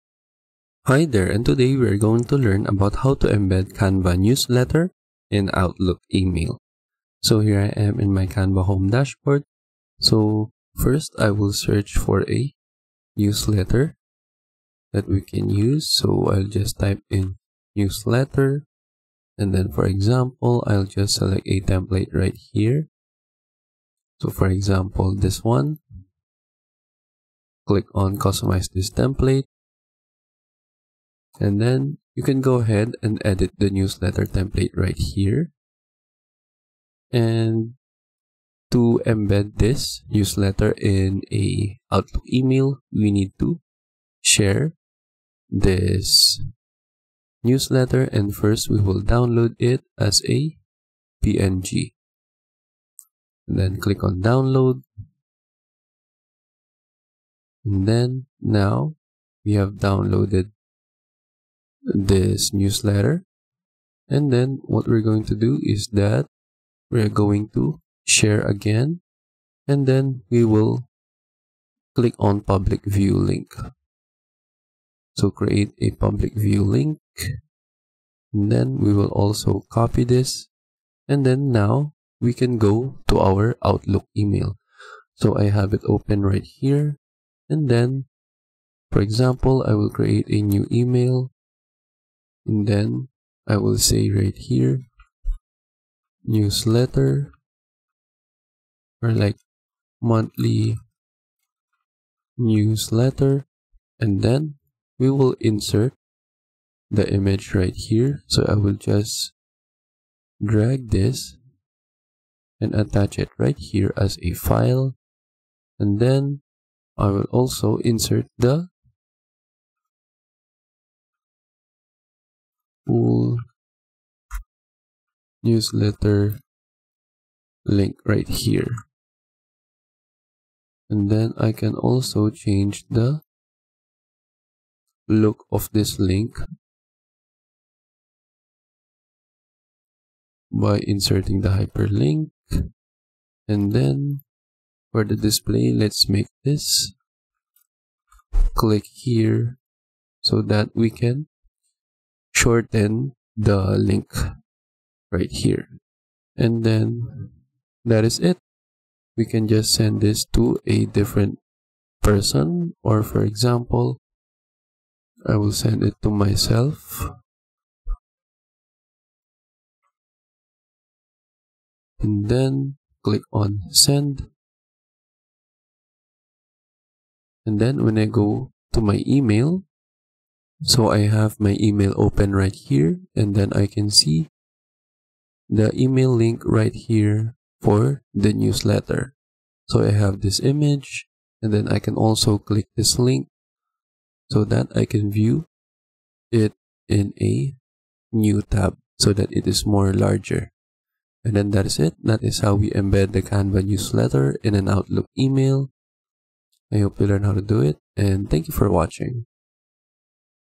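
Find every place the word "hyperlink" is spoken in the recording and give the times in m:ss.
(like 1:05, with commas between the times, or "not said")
2:21.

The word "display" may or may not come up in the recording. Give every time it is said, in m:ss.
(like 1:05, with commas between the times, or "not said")
2:25.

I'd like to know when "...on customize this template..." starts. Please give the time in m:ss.
0:27.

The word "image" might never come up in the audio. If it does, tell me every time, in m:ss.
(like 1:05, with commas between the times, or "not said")
1:47, 3:10.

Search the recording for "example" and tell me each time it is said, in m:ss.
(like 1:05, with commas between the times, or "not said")
0:19, 0:24, 1:28, 2:43.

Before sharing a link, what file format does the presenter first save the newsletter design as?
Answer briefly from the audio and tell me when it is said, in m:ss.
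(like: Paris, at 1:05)
PNG, at 0:51.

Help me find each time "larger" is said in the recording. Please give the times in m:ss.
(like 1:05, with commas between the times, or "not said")
3:19.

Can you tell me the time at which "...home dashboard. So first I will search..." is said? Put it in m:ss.
0:08.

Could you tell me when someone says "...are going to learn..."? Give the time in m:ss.
0:01.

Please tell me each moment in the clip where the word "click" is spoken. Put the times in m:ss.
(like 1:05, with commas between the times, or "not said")
0:27, 0:53, 1:11, 2:28, 2:53, 3:12.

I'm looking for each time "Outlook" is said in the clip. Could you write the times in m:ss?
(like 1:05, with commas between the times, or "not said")
0:05, 0:41, 1:23, 3:24.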